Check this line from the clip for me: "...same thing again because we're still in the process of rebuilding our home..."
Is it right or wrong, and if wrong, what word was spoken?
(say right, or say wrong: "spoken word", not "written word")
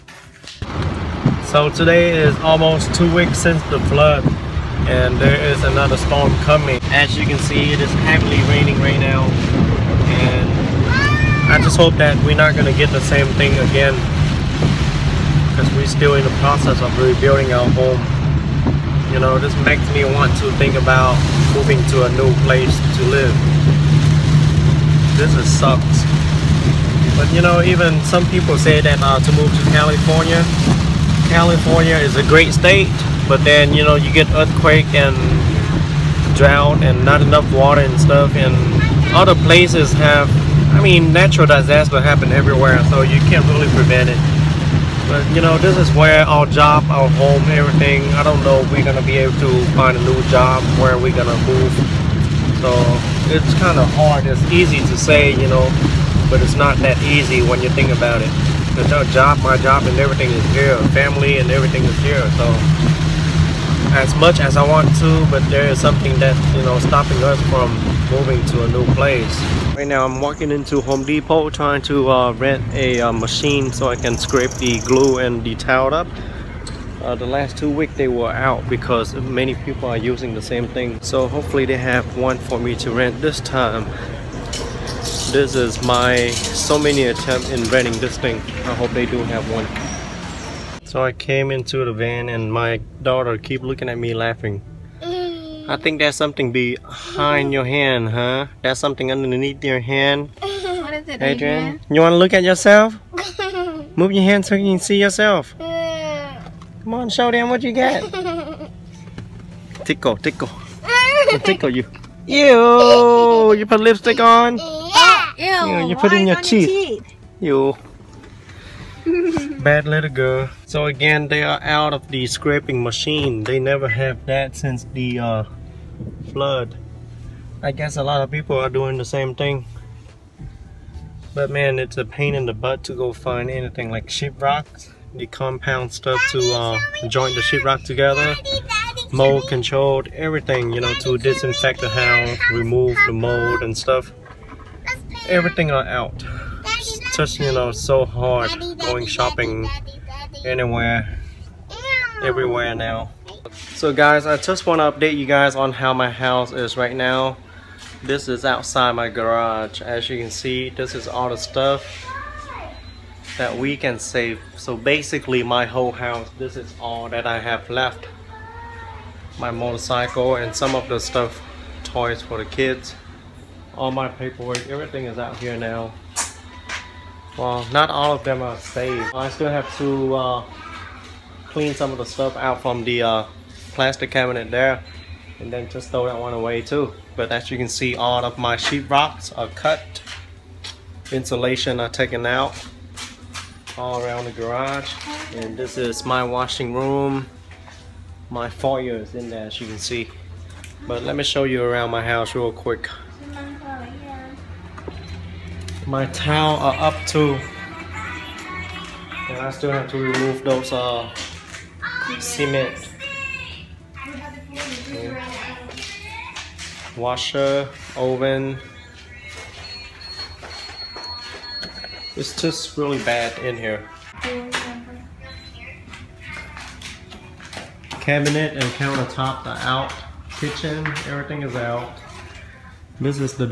right.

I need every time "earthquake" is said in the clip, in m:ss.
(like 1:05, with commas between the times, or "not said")
0:34.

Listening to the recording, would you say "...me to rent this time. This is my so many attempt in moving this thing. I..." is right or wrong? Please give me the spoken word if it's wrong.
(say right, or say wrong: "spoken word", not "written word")
wrong: "renting", not "moving".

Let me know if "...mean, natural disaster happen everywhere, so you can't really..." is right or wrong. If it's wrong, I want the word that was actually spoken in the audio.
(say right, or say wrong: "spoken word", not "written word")
right.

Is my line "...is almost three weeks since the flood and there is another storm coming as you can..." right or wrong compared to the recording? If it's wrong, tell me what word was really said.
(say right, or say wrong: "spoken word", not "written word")
wrong: "two", not "three".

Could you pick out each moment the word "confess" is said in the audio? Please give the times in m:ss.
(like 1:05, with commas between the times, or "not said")
not said.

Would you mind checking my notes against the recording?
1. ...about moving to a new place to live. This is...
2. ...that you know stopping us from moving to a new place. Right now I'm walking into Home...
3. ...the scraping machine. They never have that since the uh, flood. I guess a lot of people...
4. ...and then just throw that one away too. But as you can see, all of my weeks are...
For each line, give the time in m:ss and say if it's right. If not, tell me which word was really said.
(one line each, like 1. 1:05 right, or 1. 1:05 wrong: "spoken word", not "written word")
1. 0:20 right
2. 1:06 right
3. 2:02 right
4. 3:05 wrong: "sheetrocks", not "weeks".